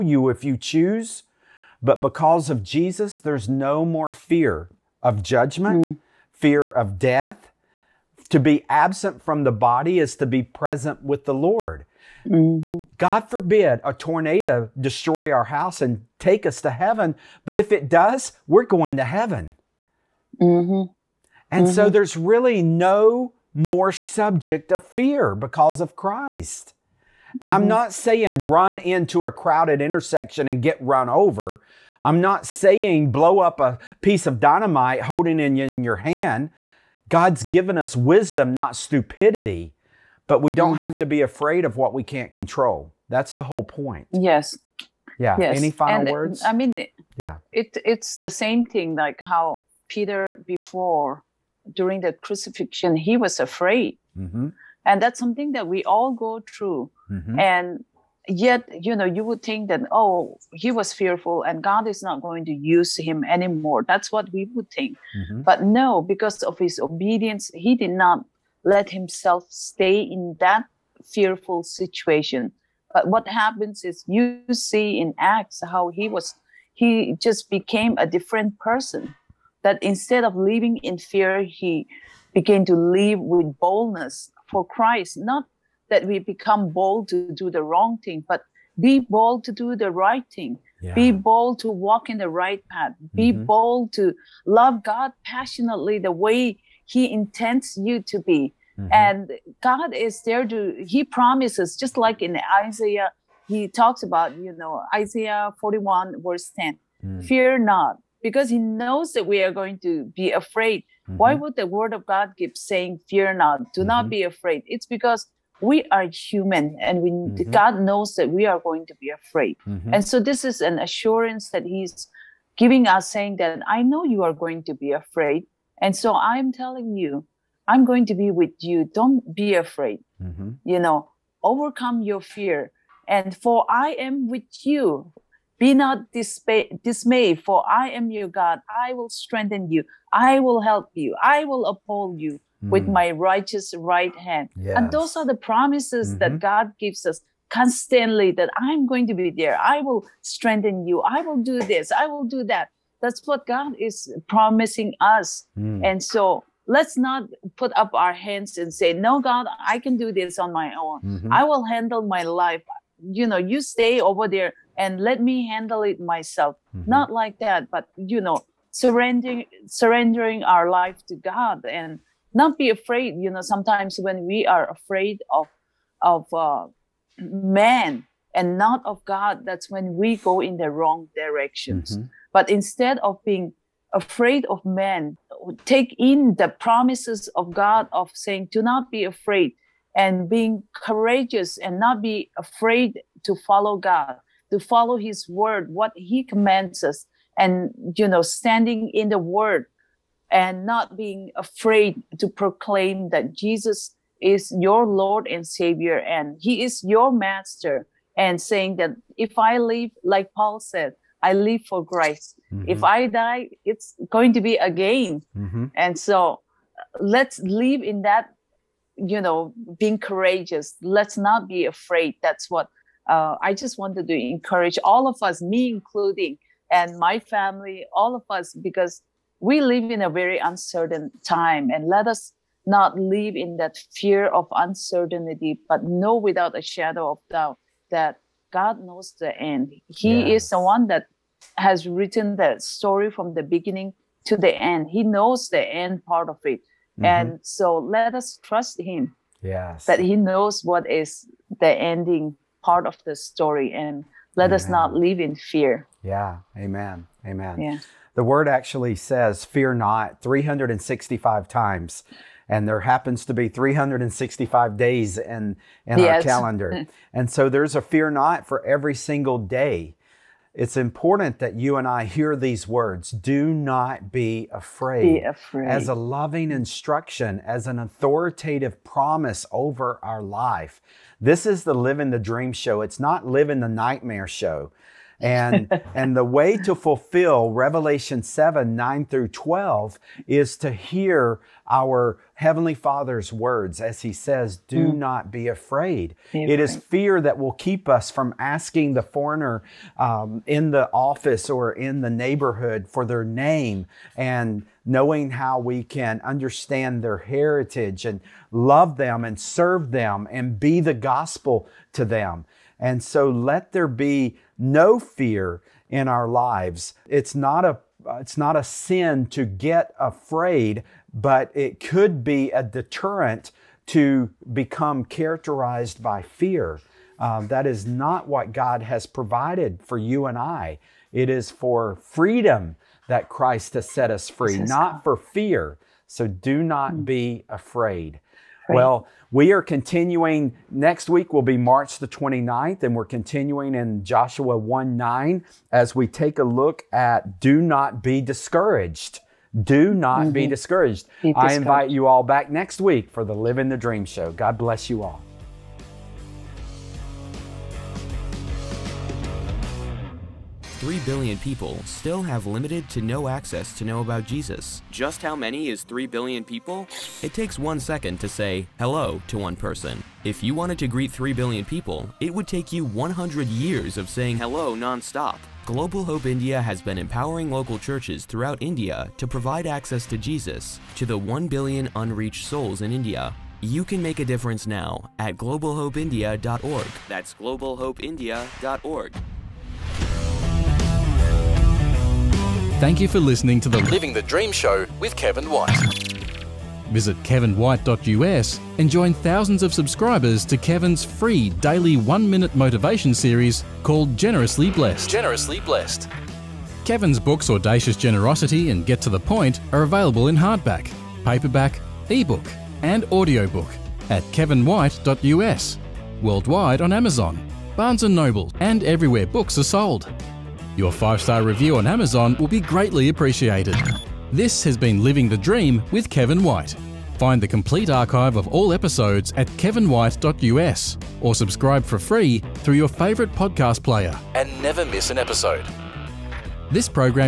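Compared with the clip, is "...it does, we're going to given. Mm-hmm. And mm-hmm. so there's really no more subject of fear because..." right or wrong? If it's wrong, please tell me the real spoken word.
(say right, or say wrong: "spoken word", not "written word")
wrong: "heaven", not "given".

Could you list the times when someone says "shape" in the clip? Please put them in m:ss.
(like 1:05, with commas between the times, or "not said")
not said.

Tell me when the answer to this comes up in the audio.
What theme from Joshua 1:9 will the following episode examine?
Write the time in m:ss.
5:47.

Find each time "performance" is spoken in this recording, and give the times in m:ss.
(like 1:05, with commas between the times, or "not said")
not said.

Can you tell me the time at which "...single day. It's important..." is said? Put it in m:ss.
4:28.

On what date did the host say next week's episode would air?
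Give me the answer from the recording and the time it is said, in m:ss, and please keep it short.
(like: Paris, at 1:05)
March 29, at 5:41.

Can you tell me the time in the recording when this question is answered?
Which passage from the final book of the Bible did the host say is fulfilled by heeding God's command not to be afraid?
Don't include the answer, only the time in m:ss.
4:47.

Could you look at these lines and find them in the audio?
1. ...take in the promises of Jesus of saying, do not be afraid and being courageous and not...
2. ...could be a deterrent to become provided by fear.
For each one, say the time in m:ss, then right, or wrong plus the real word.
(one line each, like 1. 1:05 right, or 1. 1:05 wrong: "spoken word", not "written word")
1. 3:05 wrong: "God", not "Jesus"
2. 5:21 wrong: "characterized", not "provided".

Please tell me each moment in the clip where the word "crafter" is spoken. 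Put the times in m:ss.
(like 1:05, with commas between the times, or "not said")
not said.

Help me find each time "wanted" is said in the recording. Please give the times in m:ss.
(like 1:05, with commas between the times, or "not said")
3:43, 6:10.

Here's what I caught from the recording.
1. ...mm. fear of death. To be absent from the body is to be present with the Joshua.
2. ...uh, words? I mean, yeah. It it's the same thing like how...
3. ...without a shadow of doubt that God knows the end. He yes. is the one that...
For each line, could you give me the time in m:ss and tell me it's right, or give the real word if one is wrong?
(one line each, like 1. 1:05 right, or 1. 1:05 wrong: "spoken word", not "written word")
1. 0:05 wrong: "Lord", not "Joshua"
2. 0:46 right
3. 3:56 right.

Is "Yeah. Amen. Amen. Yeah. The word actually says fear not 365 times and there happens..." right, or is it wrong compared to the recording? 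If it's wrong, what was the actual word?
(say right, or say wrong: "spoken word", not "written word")
right.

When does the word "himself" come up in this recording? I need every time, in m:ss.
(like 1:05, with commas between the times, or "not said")
1:08.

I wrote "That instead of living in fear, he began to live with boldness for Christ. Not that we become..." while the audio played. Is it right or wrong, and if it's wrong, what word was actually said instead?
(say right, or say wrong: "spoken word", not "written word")
right.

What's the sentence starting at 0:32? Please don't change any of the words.
I'm not saying blow up a piece of dynamite holding in your hand.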